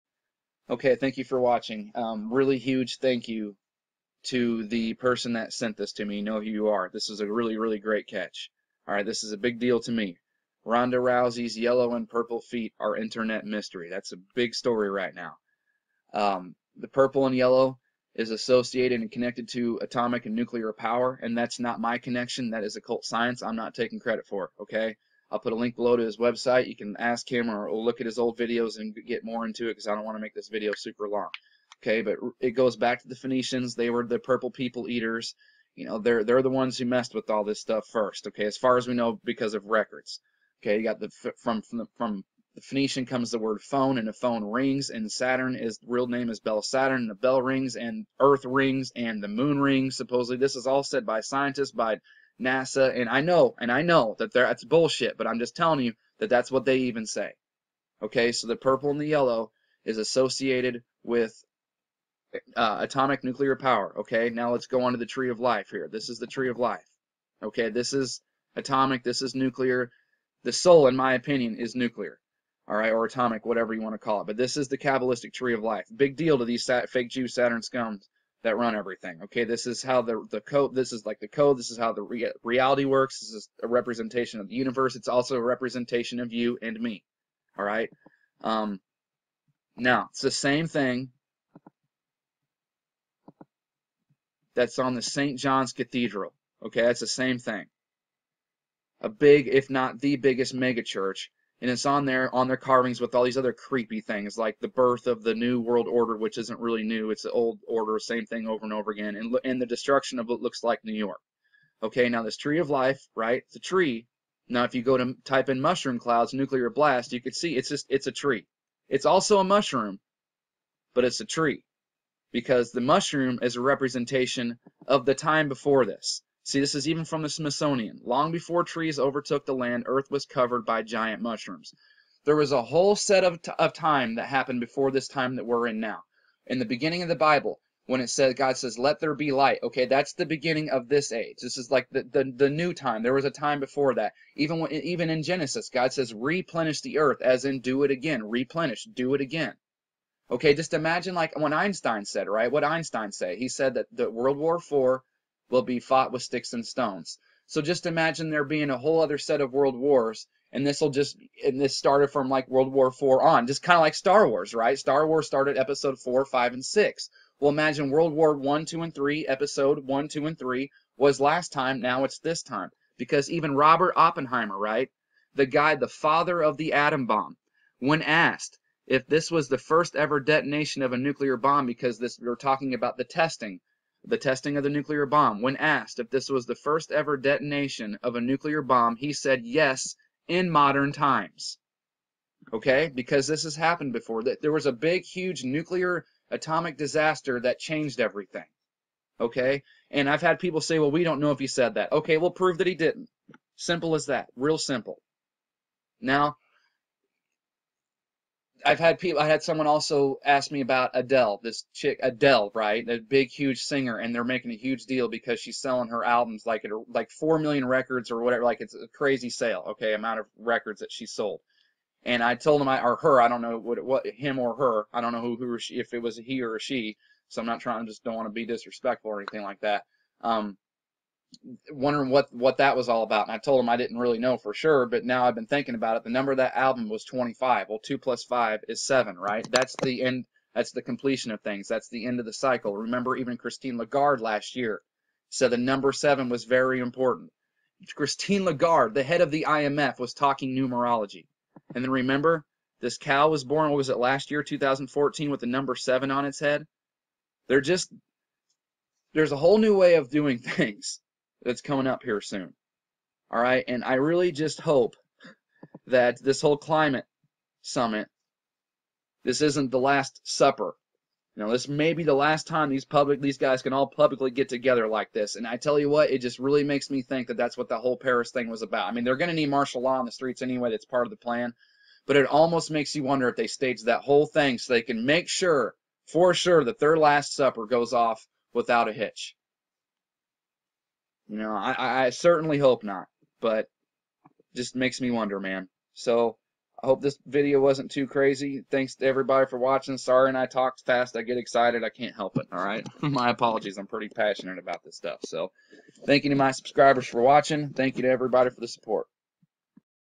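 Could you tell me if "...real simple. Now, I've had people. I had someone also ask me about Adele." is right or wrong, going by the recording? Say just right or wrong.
right.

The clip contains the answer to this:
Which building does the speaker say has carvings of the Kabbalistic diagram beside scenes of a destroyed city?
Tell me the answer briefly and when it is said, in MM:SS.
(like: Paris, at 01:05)
St. John's Cathedral, at 01:35.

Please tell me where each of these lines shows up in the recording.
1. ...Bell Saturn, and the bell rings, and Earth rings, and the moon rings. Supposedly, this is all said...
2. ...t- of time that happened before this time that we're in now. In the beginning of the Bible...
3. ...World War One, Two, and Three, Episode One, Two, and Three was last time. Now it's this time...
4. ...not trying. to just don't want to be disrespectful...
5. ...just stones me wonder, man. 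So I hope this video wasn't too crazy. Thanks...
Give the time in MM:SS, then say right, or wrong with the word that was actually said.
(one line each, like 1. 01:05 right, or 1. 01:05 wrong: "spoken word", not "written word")
1. 00:46 right
2. 02:13 right
3. 02:47 right
4. 03:47 right
5. 04:54 wrong: "makes", not "stones".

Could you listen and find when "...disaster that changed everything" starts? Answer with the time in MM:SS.
03:16.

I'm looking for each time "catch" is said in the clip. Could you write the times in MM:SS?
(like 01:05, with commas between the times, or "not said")
00:08.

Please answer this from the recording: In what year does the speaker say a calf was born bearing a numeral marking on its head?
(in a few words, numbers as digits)
2014.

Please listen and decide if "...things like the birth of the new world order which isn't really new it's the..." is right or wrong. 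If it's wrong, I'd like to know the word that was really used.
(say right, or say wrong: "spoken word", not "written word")
right.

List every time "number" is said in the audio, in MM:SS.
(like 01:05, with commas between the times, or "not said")
03:56, 04:05, 04:15.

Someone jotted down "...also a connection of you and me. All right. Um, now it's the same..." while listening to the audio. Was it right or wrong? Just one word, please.
wrong.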